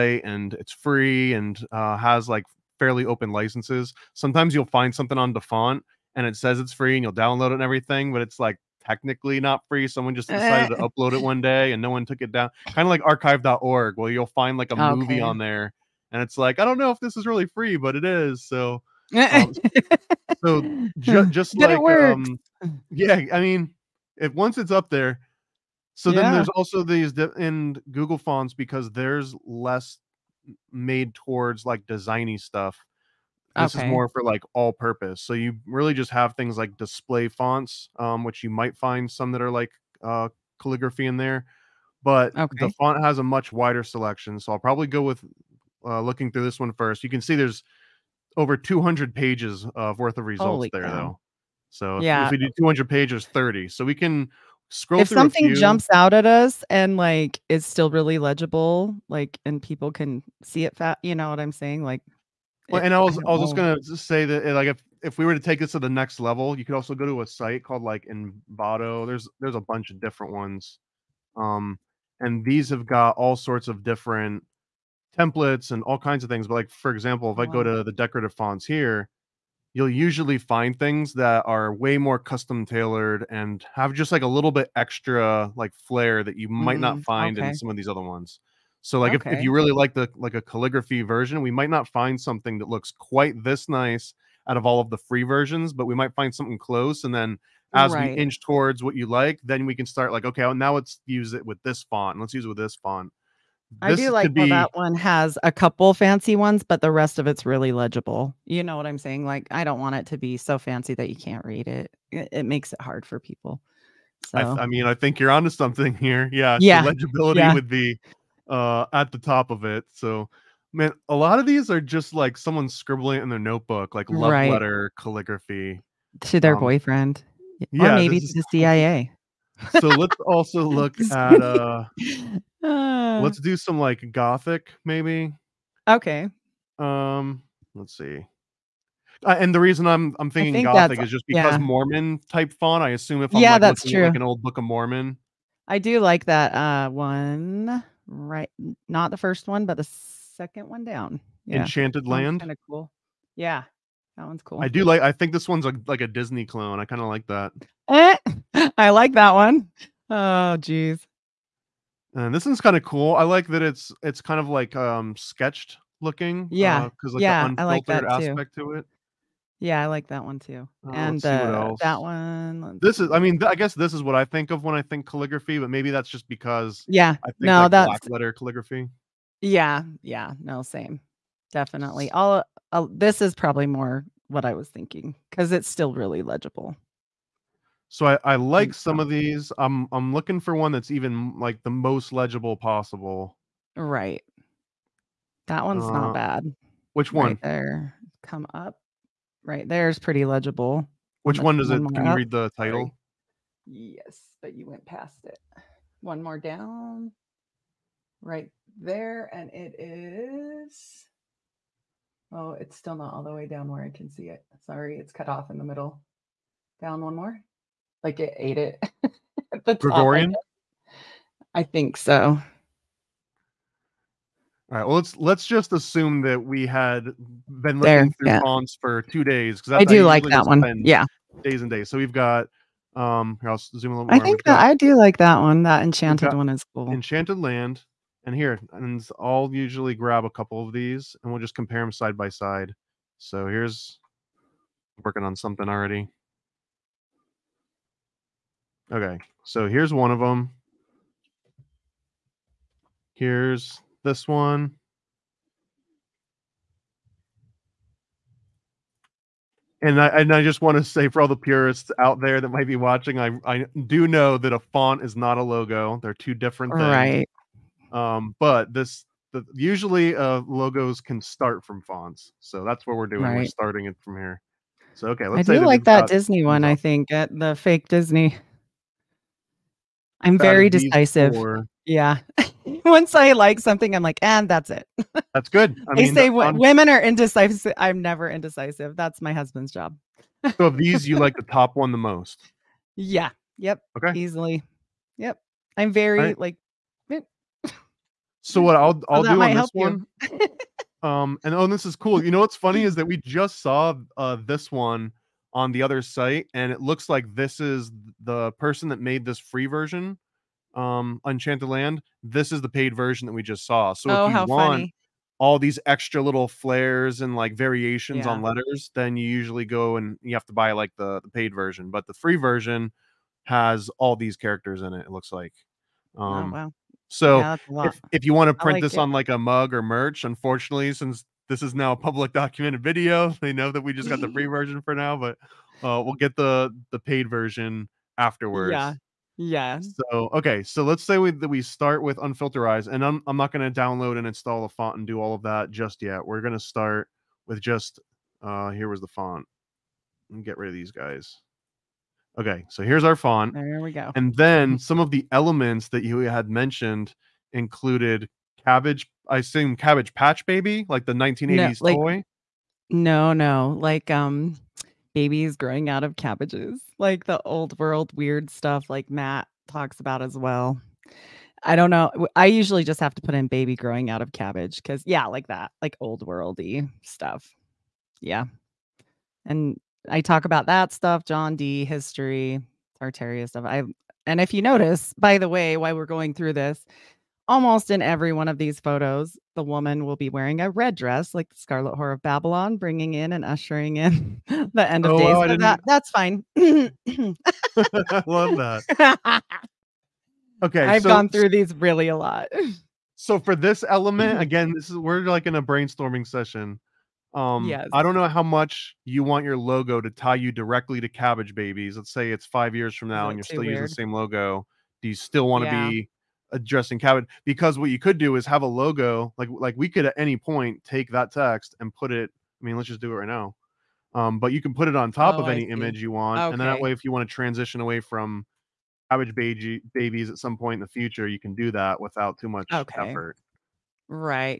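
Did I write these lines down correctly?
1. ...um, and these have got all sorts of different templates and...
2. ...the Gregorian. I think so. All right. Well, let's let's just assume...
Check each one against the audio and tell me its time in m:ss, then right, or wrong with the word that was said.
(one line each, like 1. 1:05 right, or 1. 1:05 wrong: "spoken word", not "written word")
1. 1:11 right
2. 3:39 right.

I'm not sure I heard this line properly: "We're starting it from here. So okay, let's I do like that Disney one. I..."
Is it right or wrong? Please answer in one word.
right.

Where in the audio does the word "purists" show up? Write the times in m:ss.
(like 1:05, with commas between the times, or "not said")
4:21.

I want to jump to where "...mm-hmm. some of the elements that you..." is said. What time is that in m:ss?
5:54.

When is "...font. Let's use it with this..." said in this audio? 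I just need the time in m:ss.
1:41.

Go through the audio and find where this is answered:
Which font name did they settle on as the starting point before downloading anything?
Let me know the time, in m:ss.
5:42.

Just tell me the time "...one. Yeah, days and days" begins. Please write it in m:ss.
3:50.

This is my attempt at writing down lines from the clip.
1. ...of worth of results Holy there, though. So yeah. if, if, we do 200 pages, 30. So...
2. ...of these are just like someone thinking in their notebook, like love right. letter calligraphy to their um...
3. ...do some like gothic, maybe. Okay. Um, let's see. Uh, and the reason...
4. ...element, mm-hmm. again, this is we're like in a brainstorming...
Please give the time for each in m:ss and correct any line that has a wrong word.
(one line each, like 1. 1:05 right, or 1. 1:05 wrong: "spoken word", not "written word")
1. 0:49 right
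2. 2:01 wrong: "scribbling", not "thinking"
3. 2:13 right
4. 6:43 right.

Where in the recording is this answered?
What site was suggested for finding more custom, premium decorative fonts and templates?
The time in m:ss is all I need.
1:08.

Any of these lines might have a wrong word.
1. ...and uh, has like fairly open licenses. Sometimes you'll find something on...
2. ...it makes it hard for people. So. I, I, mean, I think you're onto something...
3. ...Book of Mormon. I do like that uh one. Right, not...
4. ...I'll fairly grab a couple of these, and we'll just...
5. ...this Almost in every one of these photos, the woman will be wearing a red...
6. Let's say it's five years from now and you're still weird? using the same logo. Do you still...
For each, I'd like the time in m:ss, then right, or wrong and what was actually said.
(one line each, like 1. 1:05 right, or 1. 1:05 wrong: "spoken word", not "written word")
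1. 0:01 right
2. 1:52 right
3. 2:24 right
4. 3:59 wrong: "usually", not "fairly"
5. 6:26 right
6. 6:51 right.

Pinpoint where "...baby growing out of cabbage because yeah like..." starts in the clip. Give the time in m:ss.
6:13.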